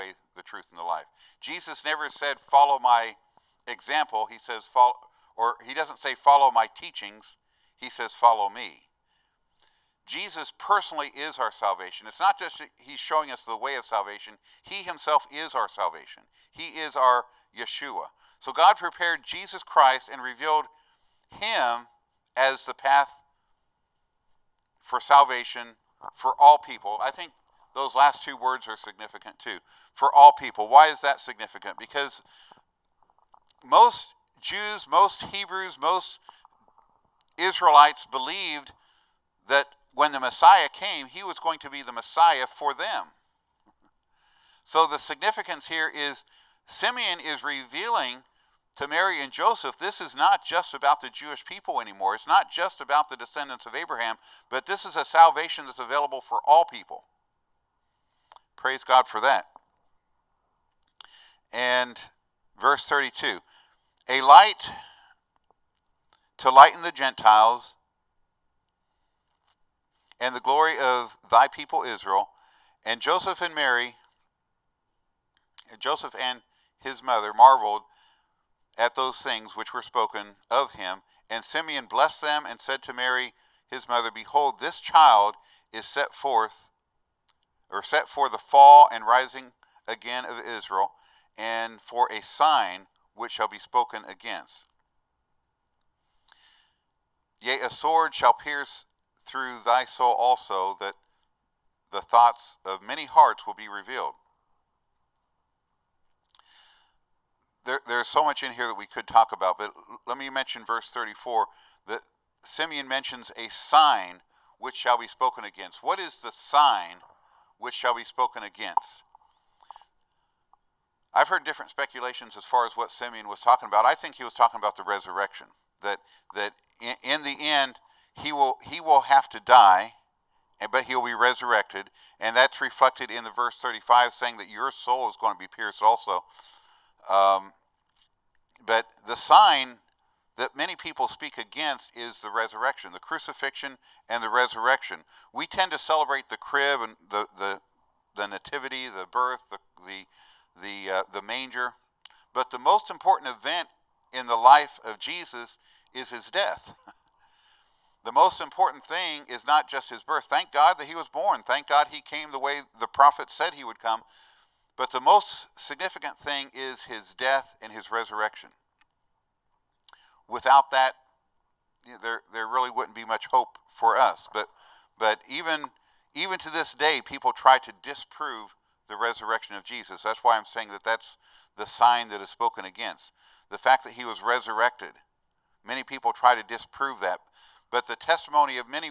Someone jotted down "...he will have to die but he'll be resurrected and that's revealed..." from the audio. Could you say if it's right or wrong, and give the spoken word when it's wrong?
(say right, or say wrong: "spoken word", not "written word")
wrong: "reflected", not "revealed".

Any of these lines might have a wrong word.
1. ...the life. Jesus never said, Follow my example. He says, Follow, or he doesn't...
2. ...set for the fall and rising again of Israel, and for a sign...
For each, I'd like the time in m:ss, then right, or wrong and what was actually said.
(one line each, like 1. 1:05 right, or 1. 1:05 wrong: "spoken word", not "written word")
1. 0:00 right
2. 1:27 right.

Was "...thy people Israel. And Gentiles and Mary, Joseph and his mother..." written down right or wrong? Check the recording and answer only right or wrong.
wrong.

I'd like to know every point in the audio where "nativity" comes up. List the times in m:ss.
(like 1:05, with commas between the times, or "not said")
2:28.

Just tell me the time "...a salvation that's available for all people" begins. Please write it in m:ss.
0:54.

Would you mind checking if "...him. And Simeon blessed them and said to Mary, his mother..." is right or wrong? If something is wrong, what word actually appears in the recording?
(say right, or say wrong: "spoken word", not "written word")
right.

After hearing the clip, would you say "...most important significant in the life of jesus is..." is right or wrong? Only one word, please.
wrong.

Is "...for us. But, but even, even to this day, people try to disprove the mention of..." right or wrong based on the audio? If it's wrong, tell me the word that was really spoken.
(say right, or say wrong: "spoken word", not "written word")
wrong: "resurrection", not "mention".